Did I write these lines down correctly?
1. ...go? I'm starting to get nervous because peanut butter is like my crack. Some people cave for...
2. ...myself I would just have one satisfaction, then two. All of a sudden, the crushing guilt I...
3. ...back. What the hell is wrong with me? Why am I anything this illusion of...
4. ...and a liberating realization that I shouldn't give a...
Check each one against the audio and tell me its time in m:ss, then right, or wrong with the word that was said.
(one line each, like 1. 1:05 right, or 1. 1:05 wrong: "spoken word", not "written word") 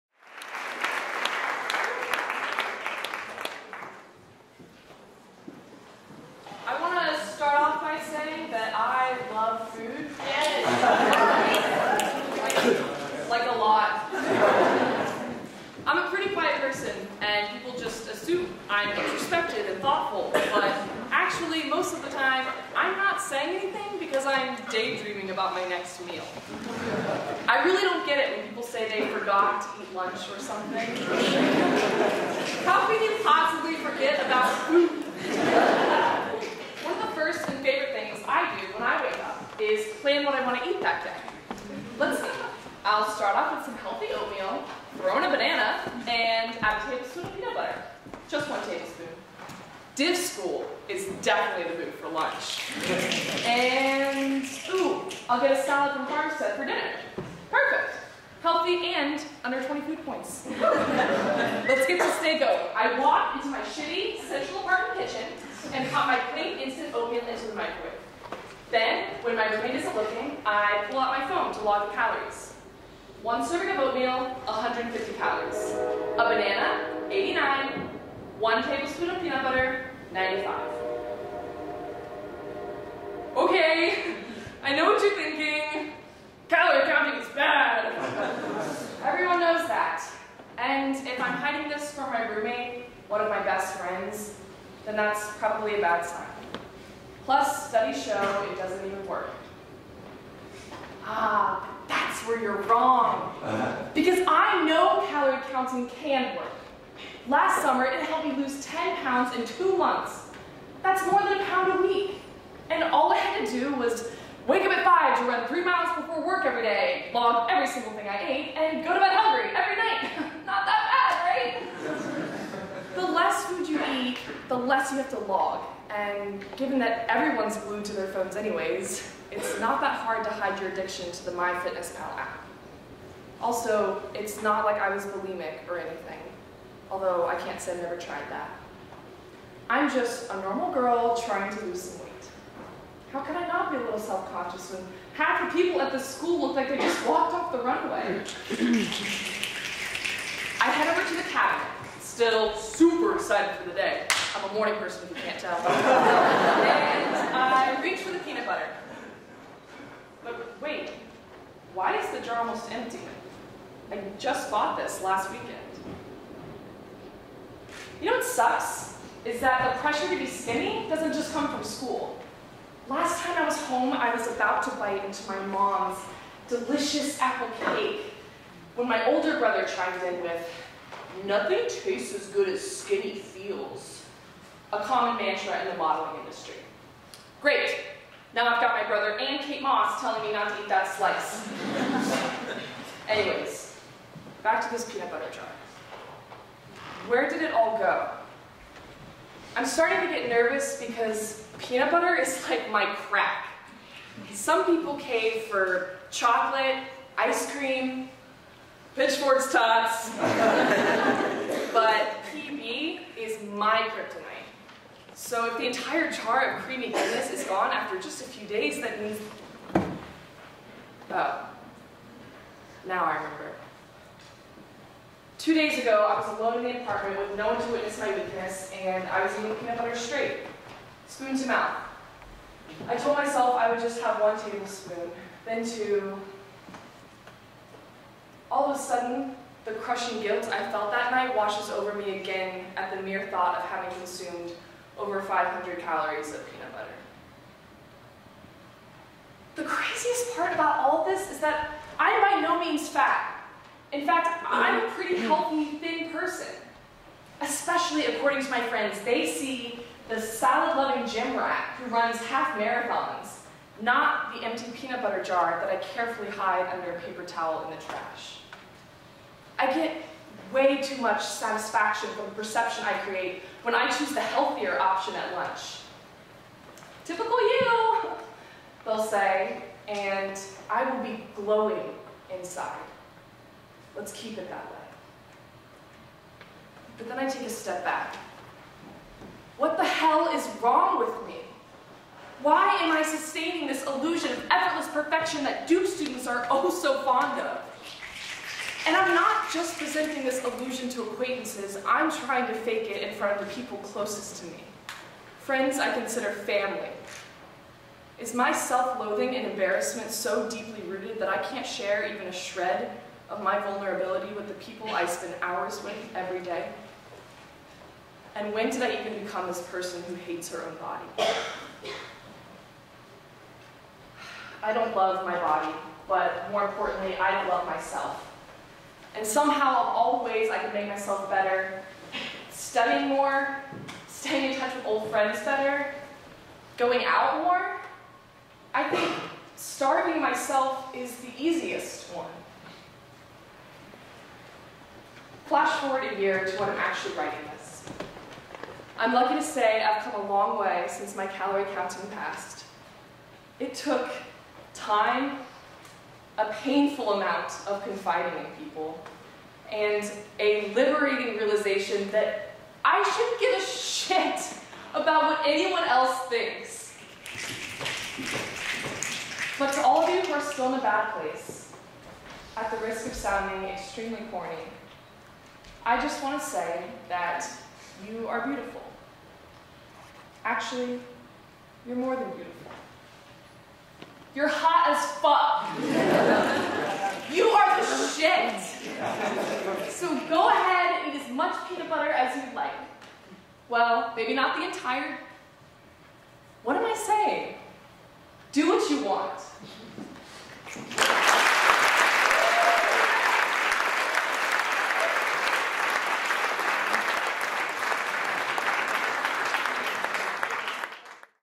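1. 3:17 right
2. 3:53 wrong: "tablespoon", not "satisfaction"
3. 4:47 wrong: "sustaining", not "anything"
4. 5:59 right.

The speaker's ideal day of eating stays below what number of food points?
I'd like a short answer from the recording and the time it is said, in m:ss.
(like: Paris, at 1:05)
20, at 0:59.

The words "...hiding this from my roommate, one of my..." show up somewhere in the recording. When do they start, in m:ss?
1:31.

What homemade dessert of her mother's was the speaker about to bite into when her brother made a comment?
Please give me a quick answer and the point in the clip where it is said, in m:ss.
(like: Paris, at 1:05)
apple cake, at 2:57.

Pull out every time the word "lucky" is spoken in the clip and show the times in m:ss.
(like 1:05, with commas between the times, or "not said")
5:49.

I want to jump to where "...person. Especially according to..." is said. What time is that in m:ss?
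4:16.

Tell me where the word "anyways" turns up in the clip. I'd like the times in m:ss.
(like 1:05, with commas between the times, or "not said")
2:08, 3:13.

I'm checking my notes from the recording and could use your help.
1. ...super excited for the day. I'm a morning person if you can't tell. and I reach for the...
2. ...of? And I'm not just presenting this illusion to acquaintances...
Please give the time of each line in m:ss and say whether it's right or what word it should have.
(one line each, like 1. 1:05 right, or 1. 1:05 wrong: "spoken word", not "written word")
1. 2:32 right
2. 4:57 right.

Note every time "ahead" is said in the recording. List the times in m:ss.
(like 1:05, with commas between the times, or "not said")
6:30.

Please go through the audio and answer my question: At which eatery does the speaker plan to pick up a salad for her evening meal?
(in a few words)
Farmstead.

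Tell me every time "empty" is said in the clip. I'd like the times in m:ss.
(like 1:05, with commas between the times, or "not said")
2:42, 4:24.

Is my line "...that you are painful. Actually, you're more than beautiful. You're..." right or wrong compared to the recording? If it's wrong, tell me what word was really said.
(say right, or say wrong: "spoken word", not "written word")
wrong: "beautiful", not "painful".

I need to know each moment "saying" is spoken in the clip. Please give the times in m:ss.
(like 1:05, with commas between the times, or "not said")
0:23, 6:36.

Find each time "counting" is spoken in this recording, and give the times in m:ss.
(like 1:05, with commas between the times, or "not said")
1:26, 1:45, 5:51.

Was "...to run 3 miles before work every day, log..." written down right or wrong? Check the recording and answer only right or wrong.
right.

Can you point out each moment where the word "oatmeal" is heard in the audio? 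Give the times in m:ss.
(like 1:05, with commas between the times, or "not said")
0:44, 1:06, 1:13.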